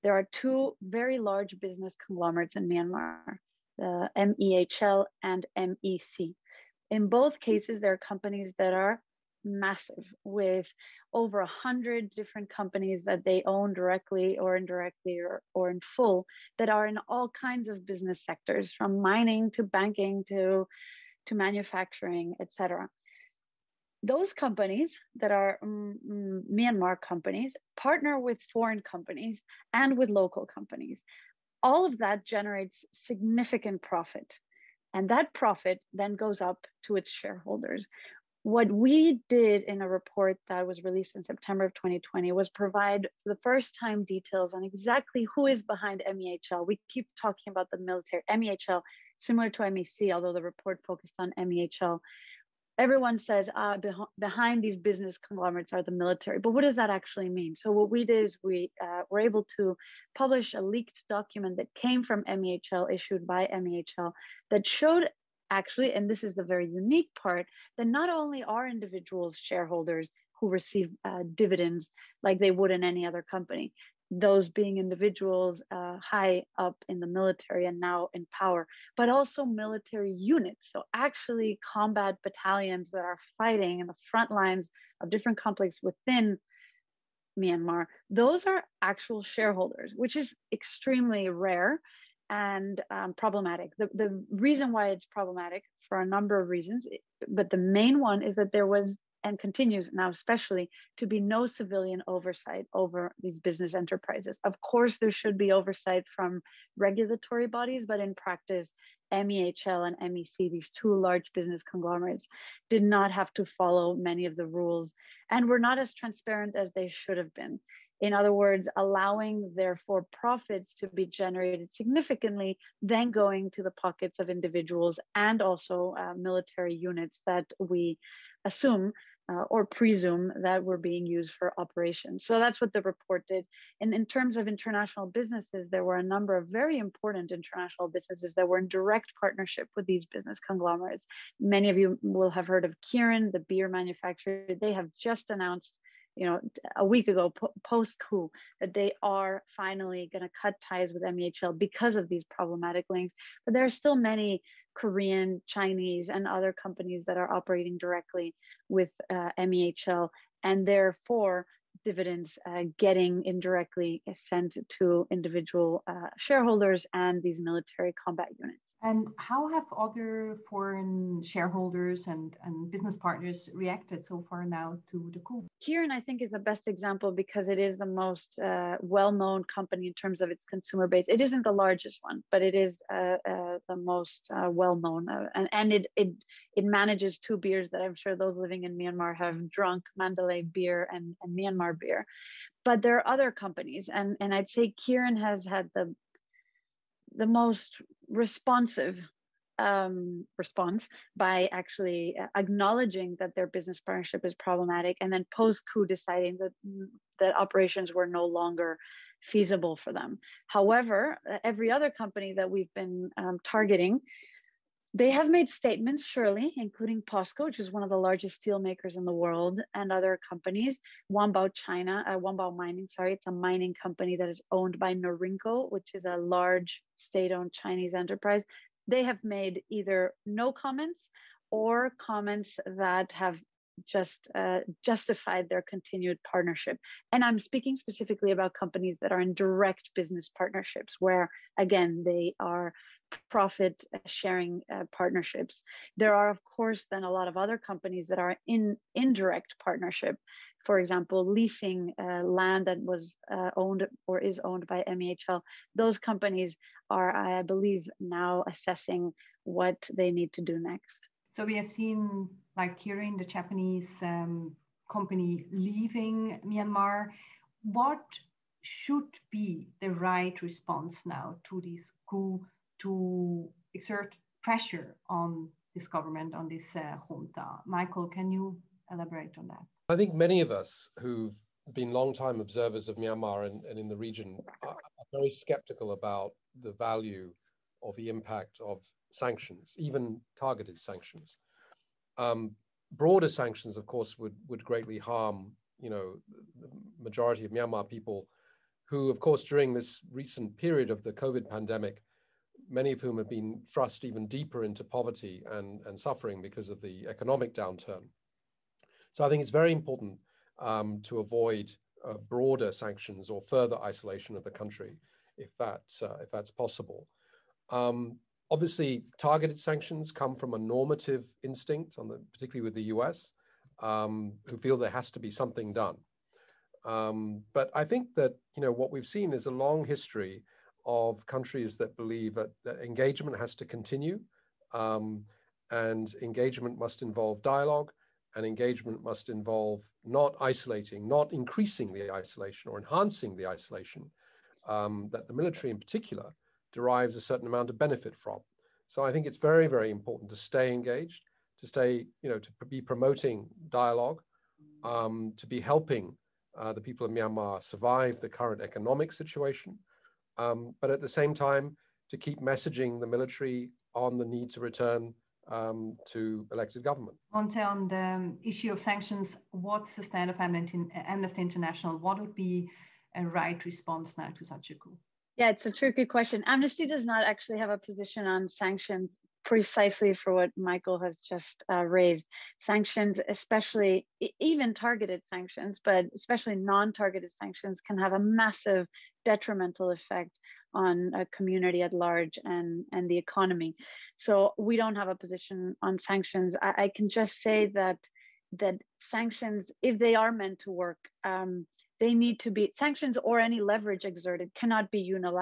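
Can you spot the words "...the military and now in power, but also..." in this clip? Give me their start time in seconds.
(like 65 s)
76 s.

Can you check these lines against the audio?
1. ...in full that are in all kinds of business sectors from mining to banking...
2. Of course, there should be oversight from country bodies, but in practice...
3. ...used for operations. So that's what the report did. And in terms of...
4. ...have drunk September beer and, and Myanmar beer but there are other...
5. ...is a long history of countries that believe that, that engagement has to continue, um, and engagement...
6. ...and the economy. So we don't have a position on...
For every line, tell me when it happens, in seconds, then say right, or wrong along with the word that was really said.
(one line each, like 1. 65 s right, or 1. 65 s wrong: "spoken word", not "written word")
1. 15 s right
2. 104 s wrong: "regulatory", not "country"
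3. 131 s right
4. 189 s wrong: "Mandalay", not "September"
5. 329 s right
6. 392 s right.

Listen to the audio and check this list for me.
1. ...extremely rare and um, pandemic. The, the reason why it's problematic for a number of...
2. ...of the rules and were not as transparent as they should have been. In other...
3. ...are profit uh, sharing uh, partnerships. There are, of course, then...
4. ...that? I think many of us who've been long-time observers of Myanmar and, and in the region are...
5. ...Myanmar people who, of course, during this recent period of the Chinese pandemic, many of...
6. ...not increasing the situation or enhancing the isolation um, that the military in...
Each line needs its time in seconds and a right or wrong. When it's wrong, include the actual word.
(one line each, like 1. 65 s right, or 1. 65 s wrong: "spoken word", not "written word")
1. 90 s wrong: "problematic", not "pandemic"
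2. 114 s right
3. 242 s right
4. 279 s right
5. 297 s wrong: "COVID", not "Chinese"
6. 341 s wrong: "isolation", not "situation".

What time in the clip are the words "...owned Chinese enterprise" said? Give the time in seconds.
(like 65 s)
227 s.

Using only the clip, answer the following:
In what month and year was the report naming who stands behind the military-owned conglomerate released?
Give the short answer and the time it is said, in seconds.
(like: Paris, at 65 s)
September 2020, at 41 s.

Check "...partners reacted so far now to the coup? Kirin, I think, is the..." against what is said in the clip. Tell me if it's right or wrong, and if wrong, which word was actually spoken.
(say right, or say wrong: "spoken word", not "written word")
right.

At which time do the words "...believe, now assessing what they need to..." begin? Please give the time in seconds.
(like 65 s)
257 s.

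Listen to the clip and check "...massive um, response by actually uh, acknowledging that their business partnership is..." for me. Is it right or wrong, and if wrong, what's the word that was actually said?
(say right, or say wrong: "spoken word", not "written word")
wrong: "responsive", not "massive".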